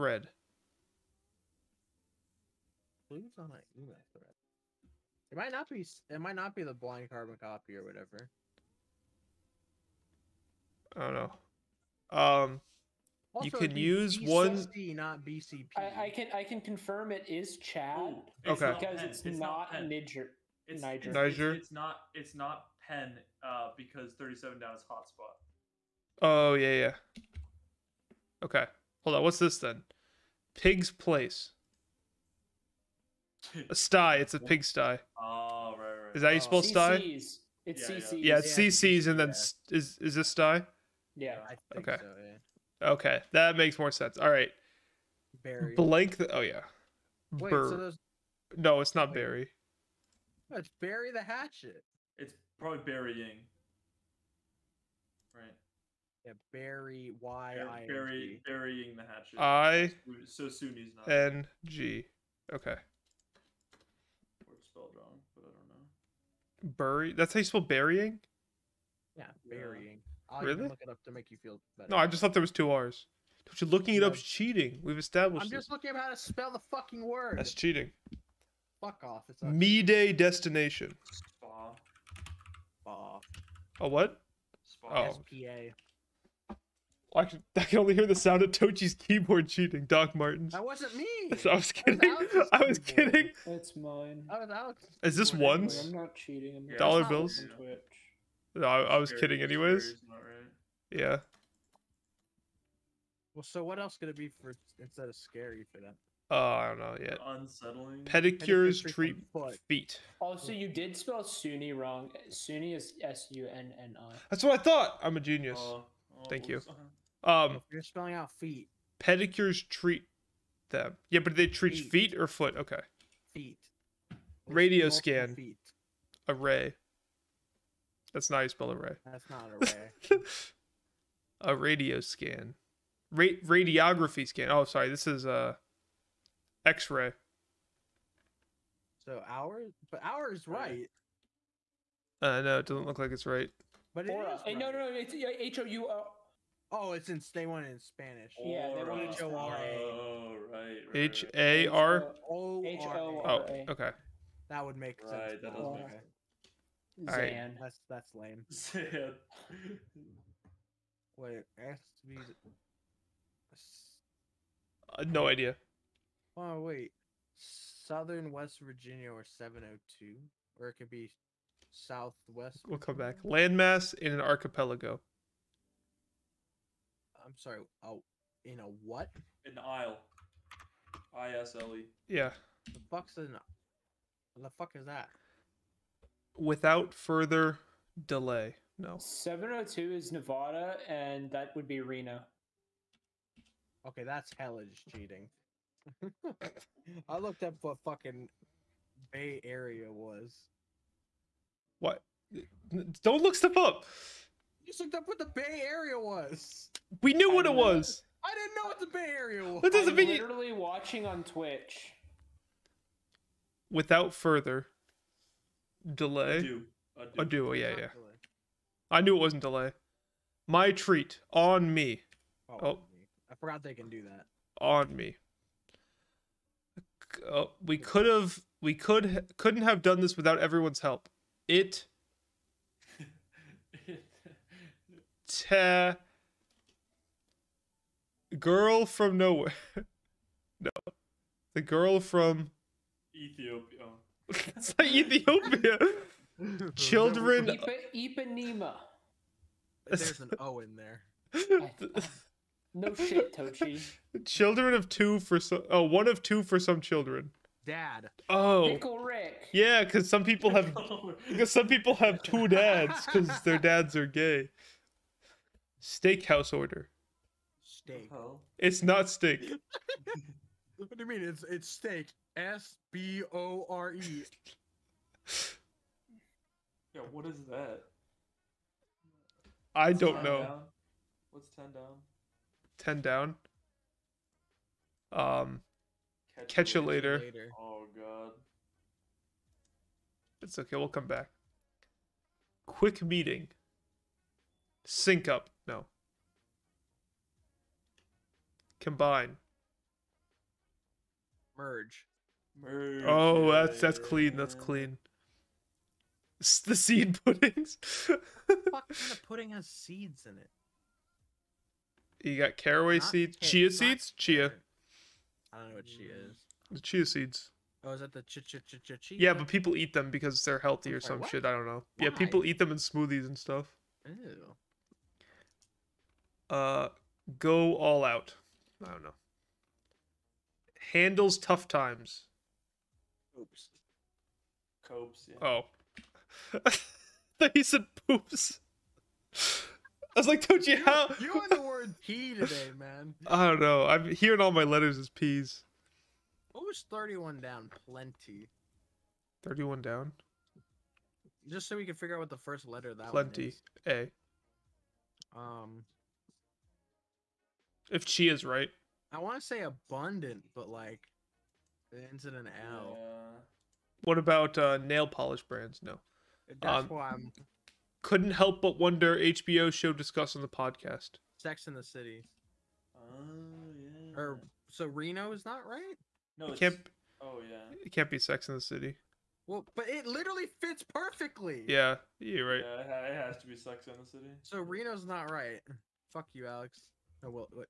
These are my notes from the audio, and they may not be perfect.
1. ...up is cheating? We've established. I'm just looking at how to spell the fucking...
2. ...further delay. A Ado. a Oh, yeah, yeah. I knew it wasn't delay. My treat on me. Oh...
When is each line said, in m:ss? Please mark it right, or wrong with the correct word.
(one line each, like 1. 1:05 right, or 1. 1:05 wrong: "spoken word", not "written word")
1. 1:14 right
2. 3:34 right.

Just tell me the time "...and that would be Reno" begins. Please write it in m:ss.
3:10.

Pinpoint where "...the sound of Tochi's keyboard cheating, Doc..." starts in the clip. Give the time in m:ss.
1:28.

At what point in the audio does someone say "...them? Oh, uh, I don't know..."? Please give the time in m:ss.
1:45.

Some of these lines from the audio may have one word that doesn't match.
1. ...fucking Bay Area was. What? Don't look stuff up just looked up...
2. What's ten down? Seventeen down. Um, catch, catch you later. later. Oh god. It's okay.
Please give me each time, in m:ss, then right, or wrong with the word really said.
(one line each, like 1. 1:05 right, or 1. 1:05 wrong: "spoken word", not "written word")
1. 3:17 right
2. 4:41 wrong: "Ten", not "Seventeen".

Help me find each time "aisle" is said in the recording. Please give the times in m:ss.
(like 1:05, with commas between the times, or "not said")
2:59.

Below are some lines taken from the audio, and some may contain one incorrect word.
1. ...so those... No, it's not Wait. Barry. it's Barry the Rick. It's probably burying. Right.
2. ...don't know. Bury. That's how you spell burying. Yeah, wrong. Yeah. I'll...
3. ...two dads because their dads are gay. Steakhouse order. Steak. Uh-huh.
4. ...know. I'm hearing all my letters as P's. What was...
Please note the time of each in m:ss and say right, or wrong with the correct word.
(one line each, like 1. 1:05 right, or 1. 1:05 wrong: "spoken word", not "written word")
1. 0:47 wrong: "Hatchet", not "Rick"
2. 1:05 wrong: "burying", not "wrong"
3. 4:22 right
4. 5:43 right.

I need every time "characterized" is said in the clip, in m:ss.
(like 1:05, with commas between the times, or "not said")
not said.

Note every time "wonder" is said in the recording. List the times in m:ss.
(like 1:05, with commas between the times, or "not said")
6:08.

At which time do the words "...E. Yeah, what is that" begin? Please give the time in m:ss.
4:33.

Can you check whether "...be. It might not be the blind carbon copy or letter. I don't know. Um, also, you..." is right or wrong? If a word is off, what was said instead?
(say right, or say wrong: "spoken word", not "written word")
wrong: "whatever", not "letter".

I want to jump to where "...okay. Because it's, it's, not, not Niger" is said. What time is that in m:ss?
0:18.